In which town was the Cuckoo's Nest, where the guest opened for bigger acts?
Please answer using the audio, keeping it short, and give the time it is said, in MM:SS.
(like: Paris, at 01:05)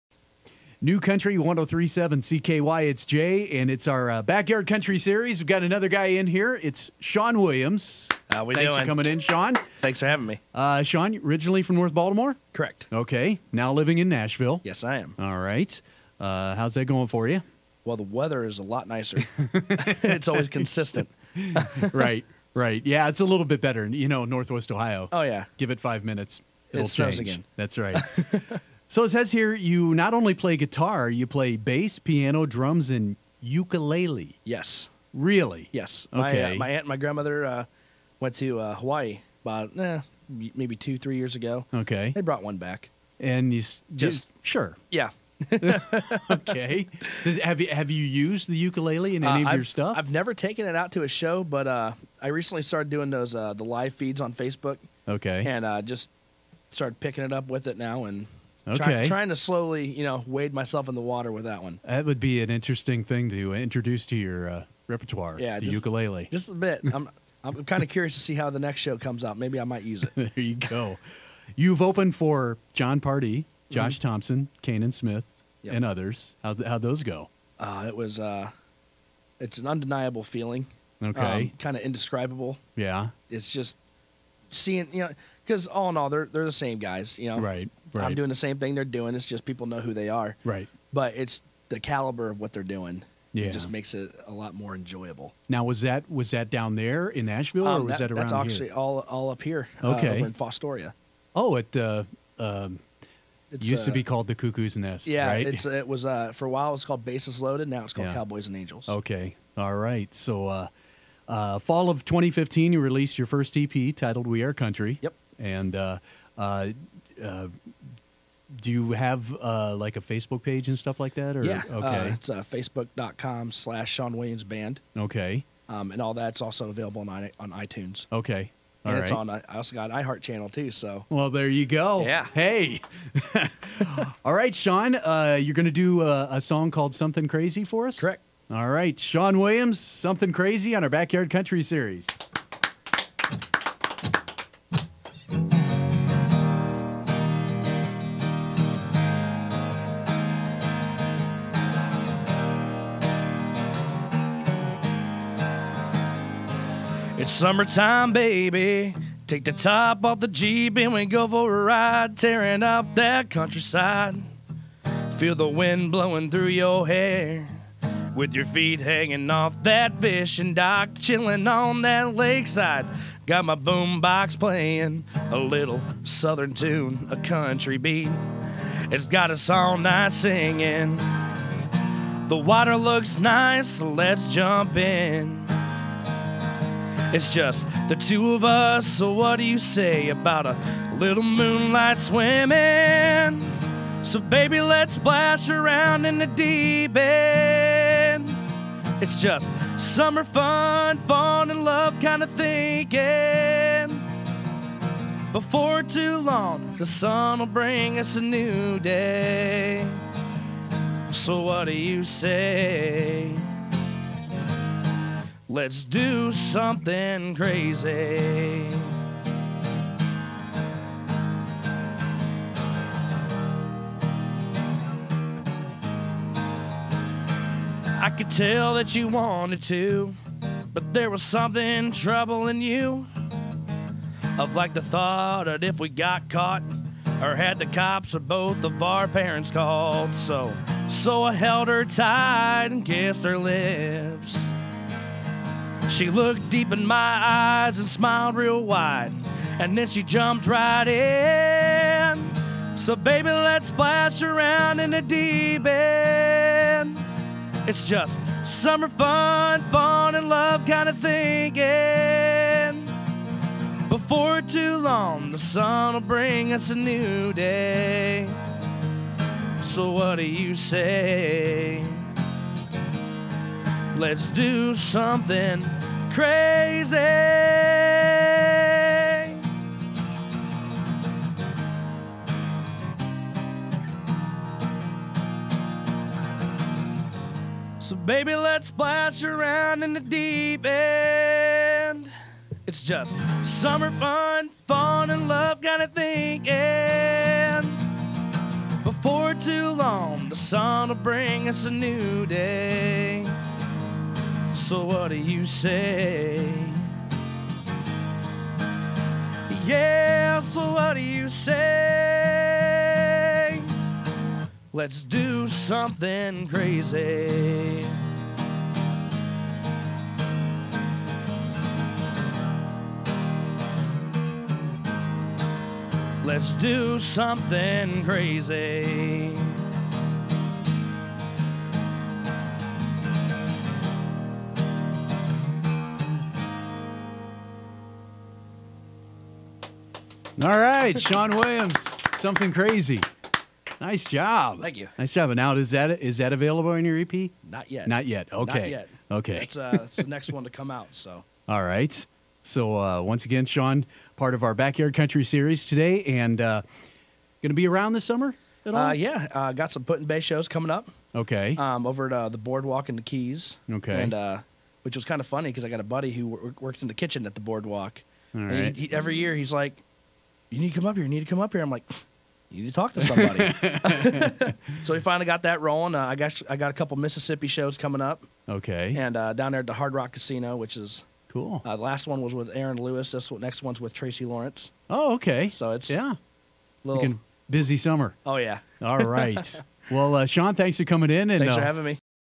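Fostoria, at 01:40.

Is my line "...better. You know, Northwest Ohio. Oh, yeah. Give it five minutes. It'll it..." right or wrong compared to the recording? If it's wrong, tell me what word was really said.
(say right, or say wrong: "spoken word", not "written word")
right.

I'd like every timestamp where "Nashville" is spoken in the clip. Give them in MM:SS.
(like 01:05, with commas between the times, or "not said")
00:14, 01:37.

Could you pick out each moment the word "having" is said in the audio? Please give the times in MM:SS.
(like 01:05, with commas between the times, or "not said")
00:10, 06:31.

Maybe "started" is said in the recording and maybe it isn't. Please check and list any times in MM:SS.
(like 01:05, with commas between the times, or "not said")
00:52, 00:56.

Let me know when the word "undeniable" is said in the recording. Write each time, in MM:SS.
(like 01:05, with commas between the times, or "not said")
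01:19.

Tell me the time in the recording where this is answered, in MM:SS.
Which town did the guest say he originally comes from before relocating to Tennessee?
00:11.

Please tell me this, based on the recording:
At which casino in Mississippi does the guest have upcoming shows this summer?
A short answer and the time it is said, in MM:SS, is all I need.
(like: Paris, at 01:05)
Hard Rock Casino, at 06:19.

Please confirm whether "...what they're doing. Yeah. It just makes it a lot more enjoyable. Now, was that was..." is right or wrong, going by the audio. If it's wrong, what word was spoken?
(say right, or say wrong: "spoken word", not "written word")
right.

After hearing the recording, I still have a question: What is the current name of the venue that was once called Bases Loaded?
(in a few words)
Cowboys and Angels.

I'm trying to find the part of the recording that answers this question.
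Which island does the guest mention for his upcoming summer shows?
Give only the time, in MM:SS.
05:59.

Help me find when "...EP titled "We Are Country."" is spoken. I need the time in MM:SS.
01:53.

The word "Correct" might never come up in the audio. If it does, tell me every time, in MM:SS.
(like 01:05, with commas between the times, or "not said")
00:12, 02:17.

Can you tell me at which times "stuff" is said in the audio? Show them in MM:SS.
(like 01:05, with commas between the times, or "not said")
00:49, 02:00.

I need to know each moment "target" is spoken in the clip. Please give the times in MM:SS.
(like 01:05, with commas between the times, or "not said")
not said.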